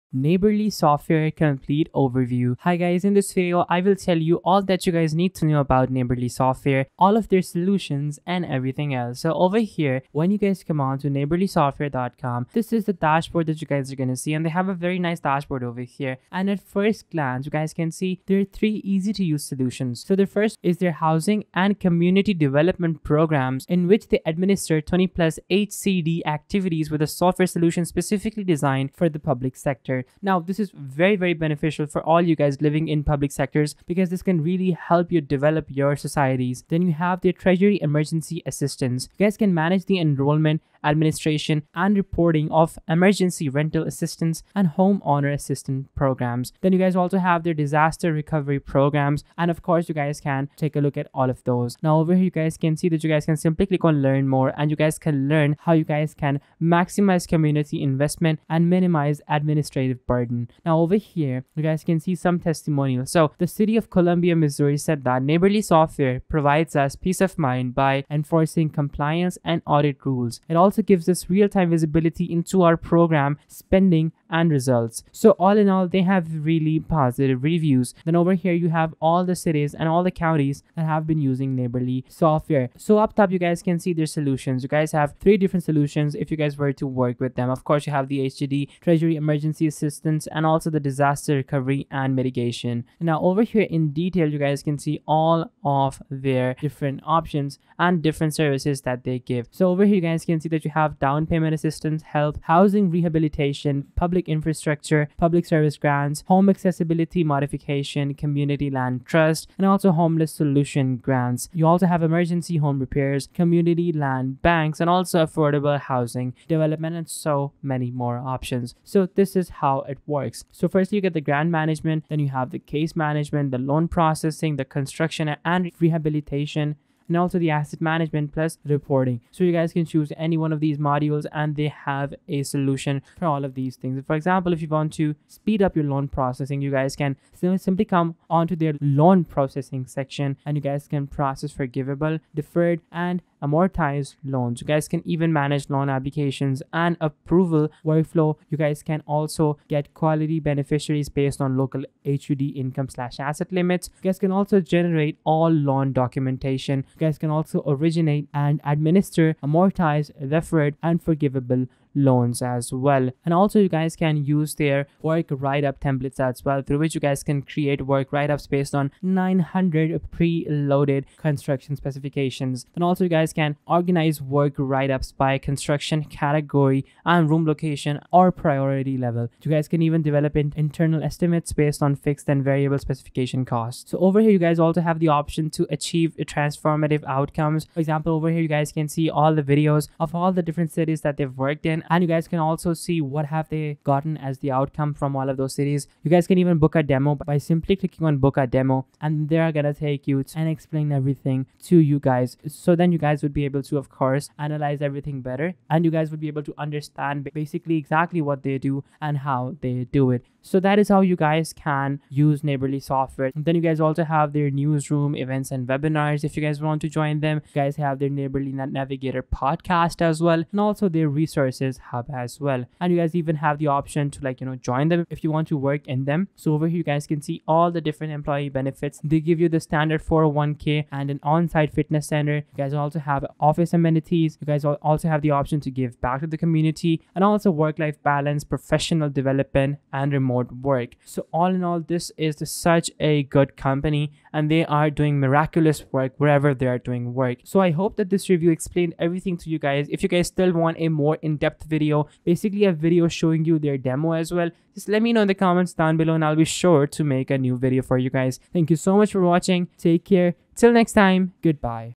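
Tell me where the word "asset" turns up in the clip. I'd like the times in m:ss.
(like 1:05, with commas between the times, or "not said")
2:07, 2:33.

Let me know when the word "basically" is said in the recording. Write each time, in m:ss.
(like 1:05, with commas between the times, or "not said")
3:27, 4:12.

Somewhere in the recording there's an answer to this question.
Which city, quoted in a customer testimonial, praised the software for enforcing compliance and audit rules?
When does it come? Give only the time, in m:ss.
1:03.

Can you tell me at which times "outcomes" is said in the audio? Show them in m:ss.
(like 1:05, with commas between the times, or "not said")
3:07, 3:14.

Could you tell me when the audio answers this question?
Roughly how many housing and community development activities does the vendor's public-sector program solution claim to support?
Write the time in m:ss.
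0:24.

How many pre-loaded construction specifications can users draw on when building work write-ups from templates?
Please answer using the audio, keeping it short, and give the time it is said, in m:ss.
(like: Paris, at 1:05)
900, at 2:49.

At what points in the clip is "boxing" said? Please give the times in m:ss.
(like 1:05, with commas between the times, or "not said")
not said.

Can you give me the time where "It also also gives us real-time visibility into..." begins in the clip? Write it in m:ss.
1:10.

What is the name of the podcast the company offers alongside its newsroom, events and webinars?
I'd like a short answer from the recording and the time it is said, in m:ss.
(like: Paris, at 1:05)
Neighborly Navigator, at 3:38.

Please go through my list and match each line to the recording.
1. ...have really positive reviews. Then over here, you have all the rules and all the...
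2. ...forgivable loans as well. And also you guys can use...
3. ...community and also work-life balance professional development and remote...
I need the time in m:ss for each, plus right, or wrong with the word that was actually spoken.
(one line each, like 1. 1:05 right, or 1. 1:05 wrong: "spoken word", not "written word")
1. 1:16 wrong: "cities", not "rules"
2. 2:41 right
3. 3:56 right.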